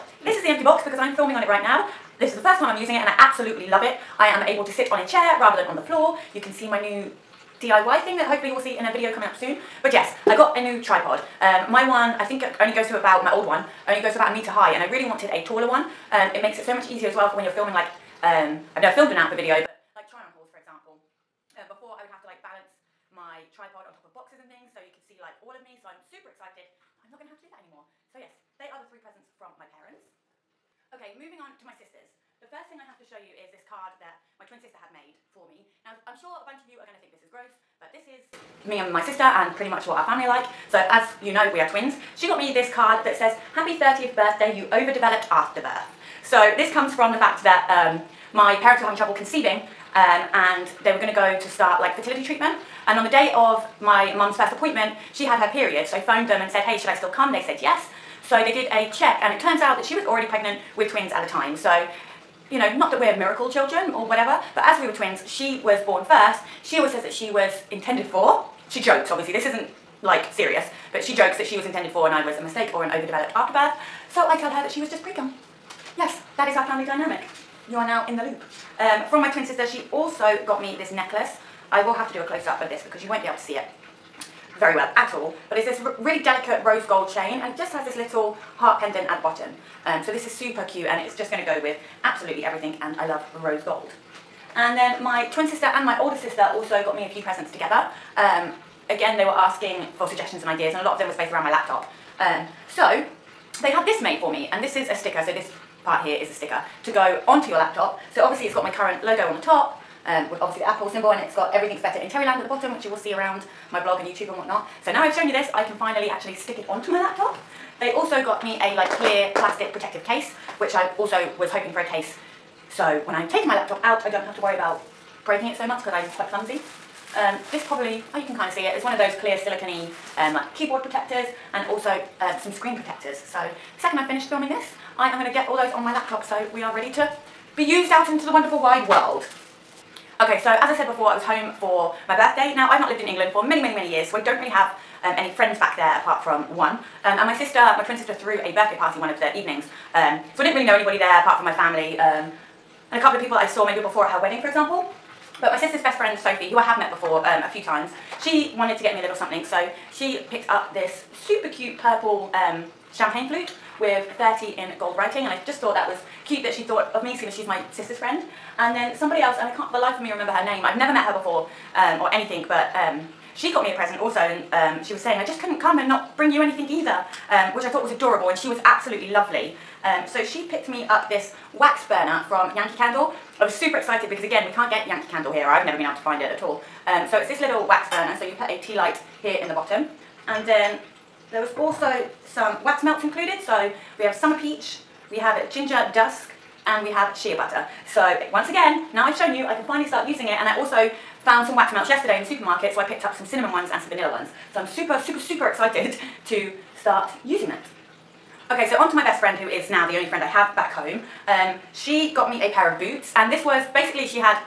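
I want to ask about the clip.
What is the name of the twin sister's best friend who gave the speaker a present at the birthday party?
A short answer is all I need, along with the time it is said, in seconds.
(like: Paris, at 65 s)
Sophie, at 156 s.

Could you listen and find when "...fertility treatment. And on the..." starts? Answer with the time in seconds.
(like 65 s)
51 s.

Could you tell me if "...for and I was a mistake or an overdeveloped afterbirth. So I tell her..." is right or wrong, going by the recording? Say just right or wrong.
right.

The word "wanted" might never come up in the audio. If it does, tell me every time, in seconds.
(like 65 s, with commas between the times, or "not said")
15 s, 158 s.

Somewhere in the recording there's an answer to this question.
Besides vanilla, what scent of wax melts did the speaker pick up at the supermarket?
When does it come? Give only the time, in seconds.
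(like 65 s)
203 s.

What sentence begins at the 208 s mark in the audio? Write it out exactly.
Okay, so on to my best friend who is now the only friend I have back home.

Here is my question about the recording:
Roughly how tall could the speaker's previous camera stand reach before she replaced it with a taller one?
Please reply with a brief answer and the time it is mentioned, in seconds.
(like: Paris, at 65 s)
1 metre, at 14 s.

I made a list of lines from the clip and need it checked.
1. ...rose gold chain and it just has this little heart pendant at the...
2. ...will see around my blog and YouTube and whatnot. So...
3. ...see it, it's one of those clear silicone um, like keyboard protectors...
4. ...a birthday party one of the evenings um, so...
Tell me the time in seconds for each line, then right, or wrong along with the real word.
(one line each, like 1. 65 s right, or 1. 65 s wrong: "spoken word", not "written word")
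1. 86 s right
2. 112 s right
3. 128 s right
4. 148 s right.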